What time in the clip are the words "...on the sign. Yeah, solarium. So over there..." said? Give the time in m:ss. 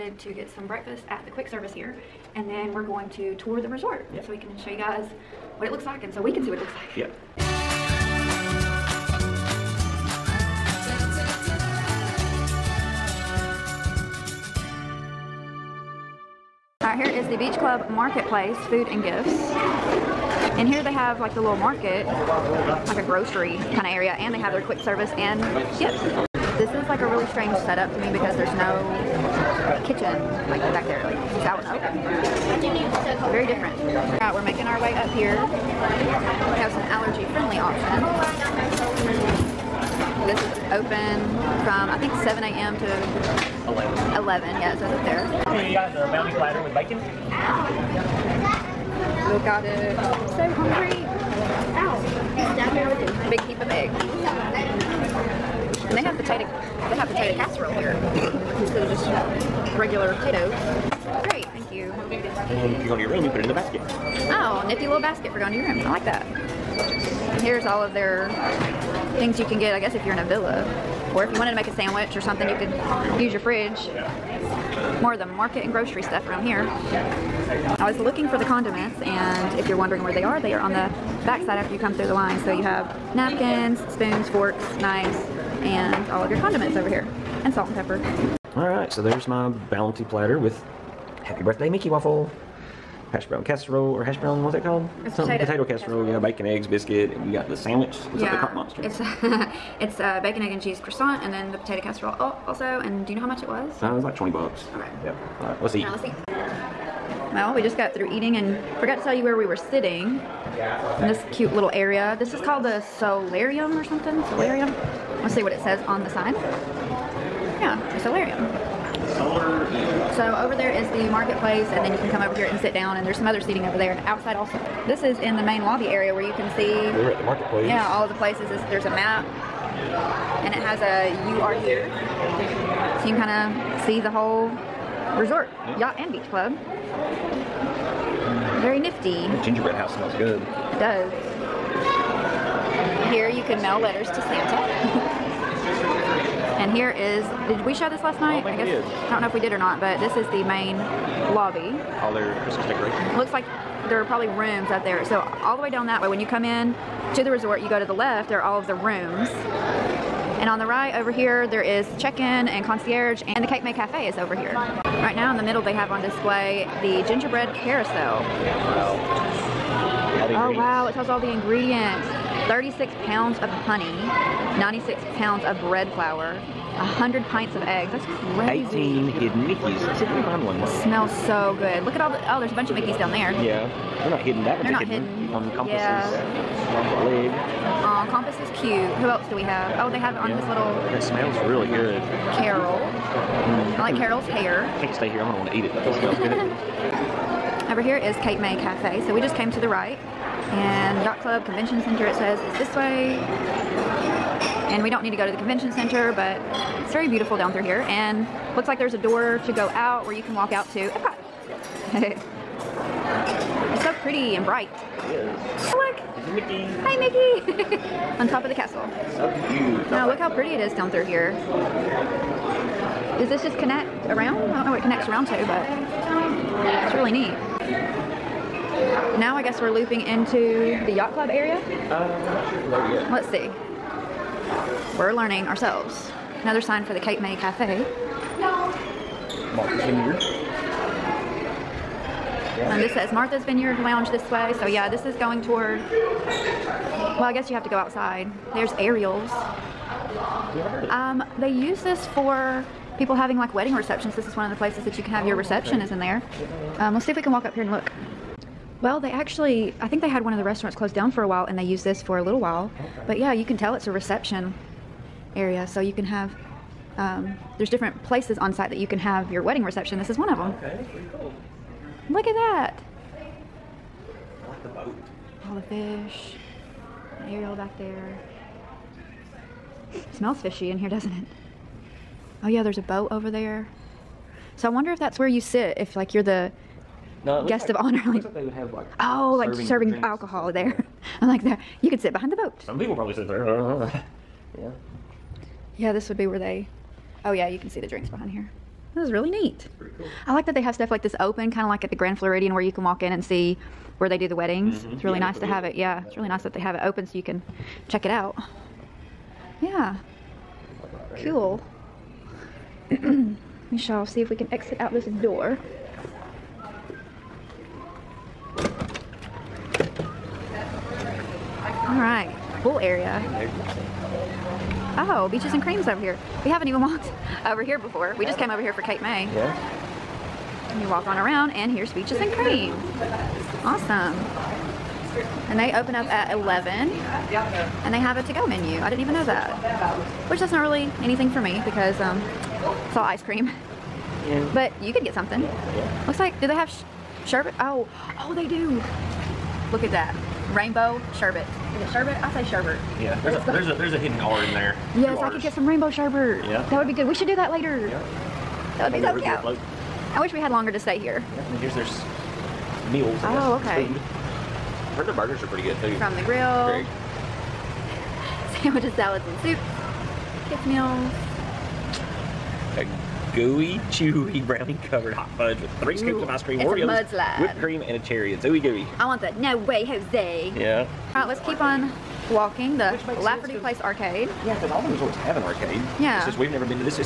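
1:55.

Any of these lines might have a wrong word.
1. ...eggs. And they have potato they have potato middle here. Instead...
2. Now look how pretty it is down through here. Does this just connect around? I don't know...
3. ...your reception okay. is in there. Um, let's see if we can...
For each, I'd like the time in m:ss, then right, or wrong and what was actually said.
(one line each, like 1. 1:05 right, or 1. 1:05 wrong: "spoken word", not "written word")
1. 0:53 wrong: "casserole", not "middle"
2. 3:39 right
3. 4:15 right.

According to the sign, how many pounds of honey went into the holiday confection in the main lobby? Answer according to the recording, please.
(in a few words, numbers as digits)
36.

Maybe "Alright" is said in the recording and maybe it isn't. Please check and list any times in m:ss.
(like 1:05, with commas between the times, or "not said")
0:33.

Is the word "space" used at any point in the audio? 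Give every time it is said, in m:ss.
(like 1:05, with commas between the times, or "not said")
not said.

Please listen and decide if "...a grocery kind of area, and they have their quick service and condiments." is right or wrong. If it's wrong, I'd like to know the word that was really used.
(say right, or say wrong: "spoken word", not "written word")
wrong: "gifts", not "condiments".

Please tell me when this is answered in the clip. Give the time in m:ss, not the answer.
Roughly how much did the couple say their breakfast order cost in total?
1:44.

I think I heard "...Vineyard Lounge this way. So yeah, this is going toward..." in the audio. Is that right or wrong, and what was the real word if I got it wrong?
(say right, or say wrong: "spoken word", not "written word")
right.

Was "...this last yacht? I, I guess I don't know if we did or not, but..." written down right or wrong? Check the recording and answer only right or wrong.
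wrong.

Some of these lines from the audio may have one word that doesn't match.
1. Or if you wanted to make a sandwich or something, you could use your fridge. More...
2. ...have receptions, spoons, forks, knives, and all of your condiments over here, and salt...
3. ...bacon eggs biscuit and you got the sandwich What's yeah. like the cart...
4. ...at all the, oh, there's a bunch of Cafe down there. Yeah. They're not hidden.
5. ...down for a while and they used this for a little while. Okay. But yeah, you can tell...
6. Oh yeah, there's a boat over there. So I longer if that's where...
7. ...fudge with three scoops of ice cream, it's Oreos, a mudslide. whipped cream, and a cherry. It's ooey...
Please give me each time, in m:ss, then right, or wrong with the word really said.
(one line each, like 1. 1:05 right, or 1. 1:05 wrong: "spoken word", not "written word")
1. 1:11 right
2. 1:22 wrong: "napkins", not "receptions"
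3. 1:36 right
4. 3:01 wrong: "Mickeys", not "Cafe"
5. 4:20 right
6. 4:42 wrong: "wonder", not "longer"
7. 6:15 right.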